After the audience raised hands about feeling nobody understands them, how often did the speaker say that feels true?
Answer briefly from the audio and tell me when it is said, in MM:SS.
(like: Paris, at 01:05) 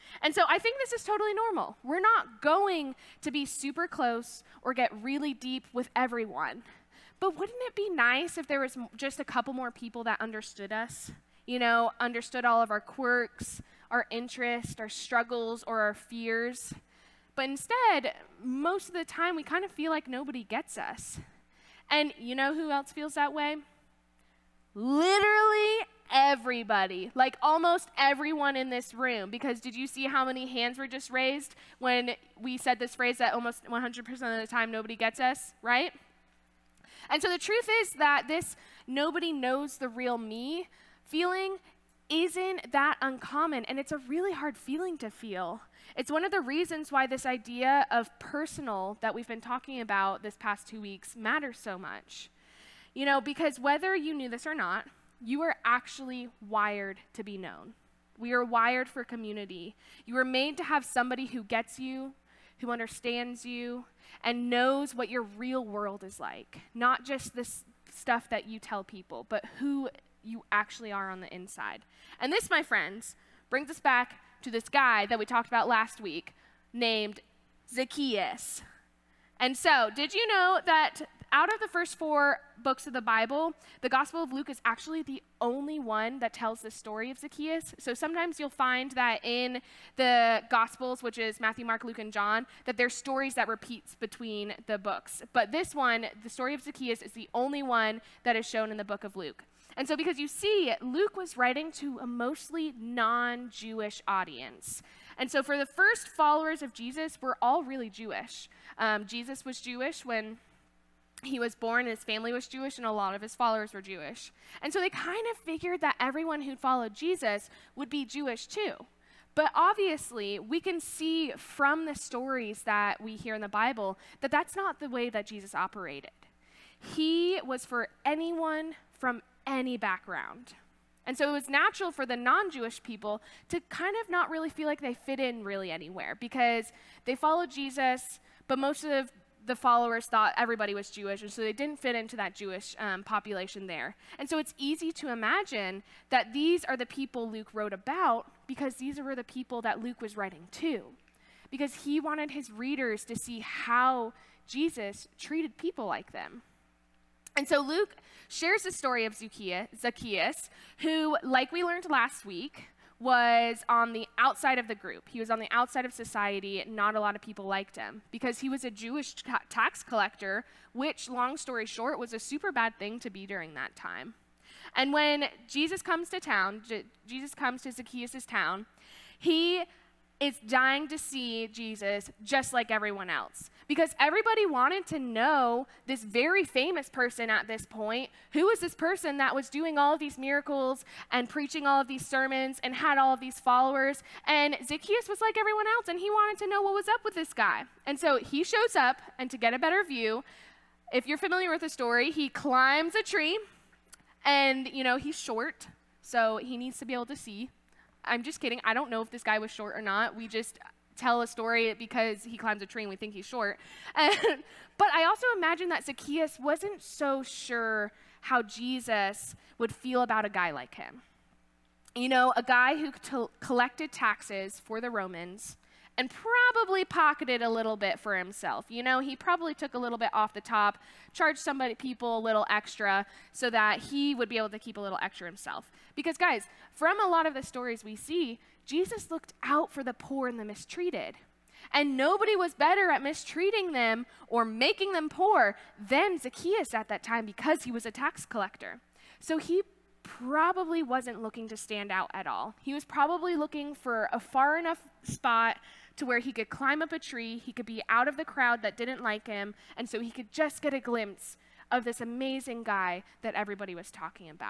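almost 100% of the time, at 00:33.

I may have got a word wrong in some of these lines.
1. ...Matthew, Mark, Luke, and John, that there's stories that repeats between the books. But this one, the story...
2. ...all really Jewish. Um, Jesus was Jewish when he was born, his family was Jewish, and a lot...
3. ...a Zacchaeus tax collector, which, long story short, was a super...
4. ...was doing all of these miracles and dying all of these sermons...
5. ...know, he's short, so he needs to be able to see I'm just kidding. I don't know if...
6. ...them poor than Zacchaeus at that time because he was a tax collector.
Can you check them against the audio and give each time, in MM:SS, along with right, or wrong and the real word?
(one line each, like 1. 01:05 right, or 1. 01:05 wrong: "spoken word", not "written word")
1. 01:31 right
2. 01:47 right
3. 02:48 wrong: "Jewish", not "Zacchaeus"
4. 03:09 wrong: "preaching", not "dying"
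5. 03:24 right
6. 04:04 right.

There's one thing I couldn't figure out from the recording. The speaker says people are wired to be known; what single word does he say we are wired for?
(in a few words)
community.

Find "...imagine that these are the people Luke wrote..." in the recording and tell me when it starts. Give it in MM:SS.
02:25.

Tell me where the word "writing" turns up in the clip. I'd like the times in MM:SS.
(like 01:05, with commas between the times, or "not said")
01:41, 02:30.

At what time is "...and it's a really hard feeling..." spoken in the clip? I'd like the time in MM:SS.
00:43.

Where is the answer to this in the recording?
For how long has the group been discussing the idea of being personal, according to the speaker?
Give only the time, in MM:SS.
00:50.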